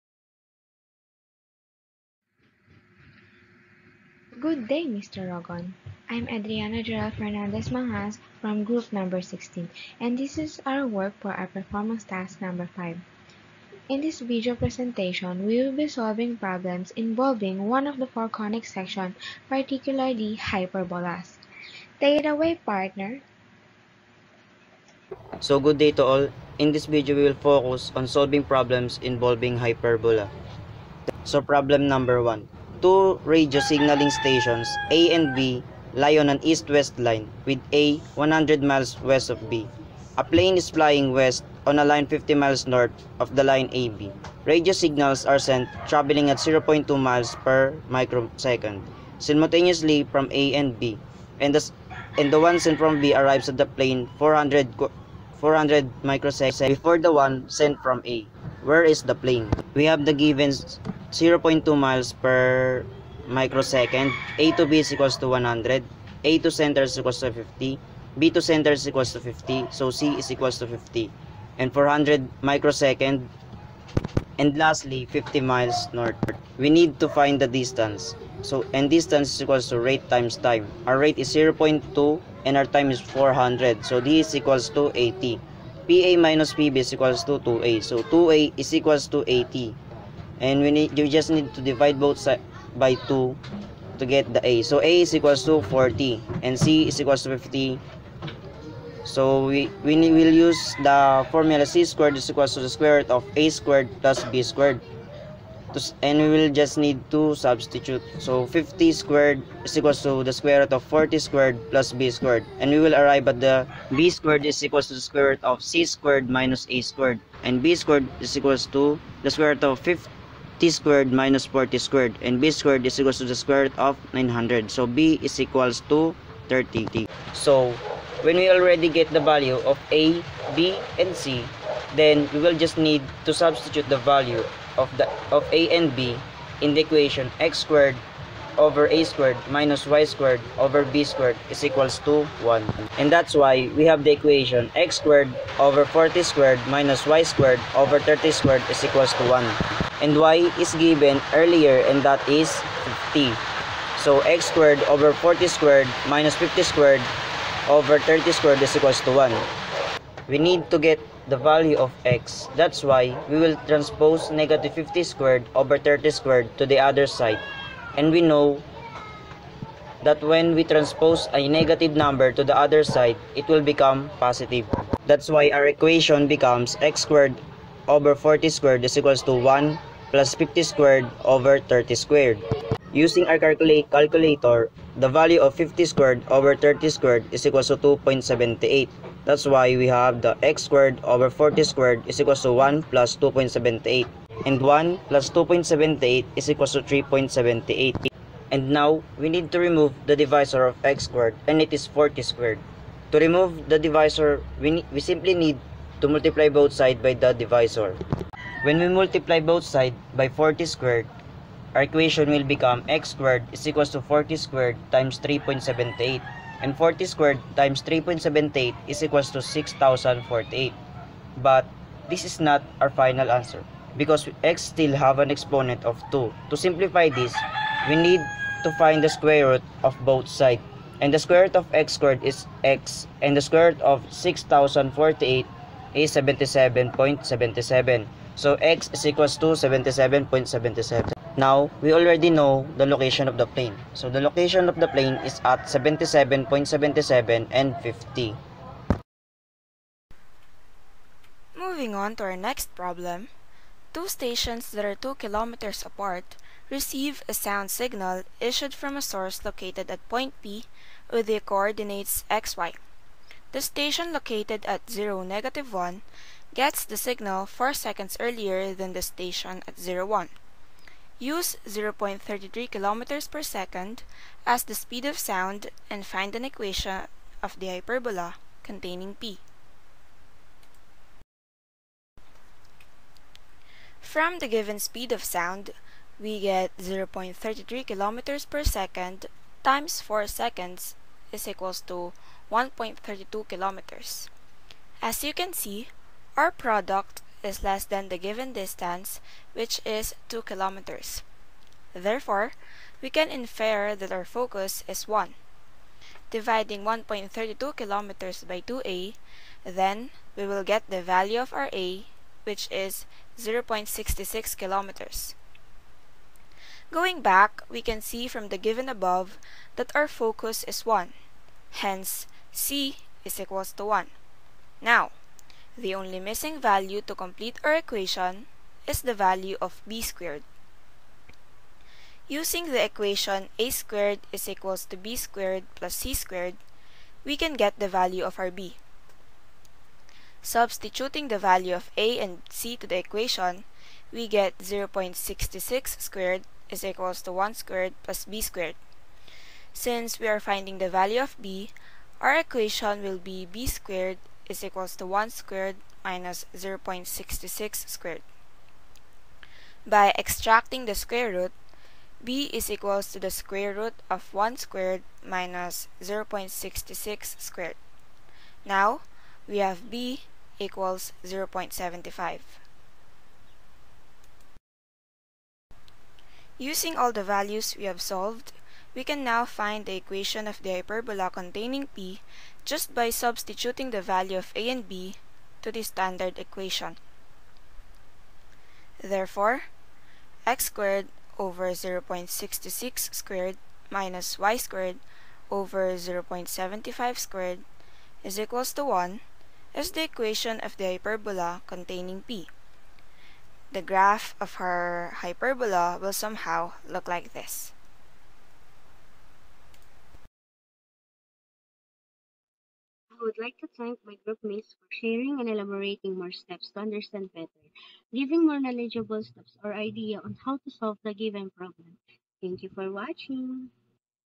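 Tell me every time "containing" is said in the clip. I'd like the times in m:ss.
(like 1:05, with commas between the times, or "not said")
4:38, 6:21, 6:41.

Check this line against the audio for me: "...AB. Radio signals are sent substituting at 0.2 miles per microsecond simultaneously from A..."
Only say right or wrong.
wrong.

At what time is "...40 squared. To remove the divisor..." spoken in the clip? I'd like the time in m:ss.
3:21.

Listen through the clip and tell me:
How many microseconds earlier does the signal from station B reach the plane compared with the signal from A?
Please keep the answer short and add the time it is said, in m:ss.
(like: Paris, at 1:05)
400, at 0:55.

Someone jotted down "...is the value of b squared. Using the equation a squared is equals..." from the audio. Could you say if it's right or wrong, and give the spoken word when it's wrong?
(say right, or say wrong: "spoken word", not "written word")
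right.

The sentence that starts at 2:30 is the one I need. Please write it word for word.
And y is given earlier and that is 50.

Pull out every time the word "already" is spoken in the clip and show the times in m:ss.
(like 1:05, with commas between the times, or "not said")
2:08, 4:01.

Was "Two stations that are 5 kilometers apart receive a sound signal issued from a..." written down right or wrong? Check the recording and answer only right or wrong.
wrong.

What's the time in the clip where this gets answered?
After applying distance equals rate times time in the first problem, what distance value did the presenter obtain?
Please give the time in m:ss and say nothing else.
1:24.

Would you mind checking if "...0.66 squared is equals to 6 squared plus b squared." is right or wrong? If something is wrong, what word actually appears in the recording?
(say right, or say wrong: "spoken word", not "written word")
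wrong: "1", not "6".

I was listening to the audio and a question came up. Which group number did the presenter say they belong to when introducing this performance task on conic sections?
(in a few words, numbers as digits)
16.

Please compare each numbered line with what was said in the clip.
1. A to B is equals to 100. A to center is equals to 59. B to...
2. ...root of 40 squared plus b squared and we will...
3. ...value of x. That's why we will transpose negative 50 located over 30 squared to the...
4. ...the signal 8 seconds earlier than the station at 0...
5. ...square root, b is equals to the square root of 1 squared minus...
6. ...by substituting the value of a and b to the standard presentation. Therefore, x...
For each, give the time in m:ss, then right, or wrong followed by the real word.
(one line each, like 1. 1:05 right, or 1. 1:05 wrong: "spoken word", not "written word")
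1. 1:04 wrong: "50", not "59"
2. 1:50 right
3. 2:41 wrong: "squared", not "located"
4. 4:26 wrong: "4", not "8"
5. 6:00 right
6. 6:22 wrong: "equation", not "presentation".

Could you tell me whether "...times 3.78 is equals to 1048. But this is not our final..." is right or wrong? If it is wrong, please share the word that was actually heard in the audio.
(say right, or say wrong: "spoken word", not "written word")
wrong: "6048", not "1048".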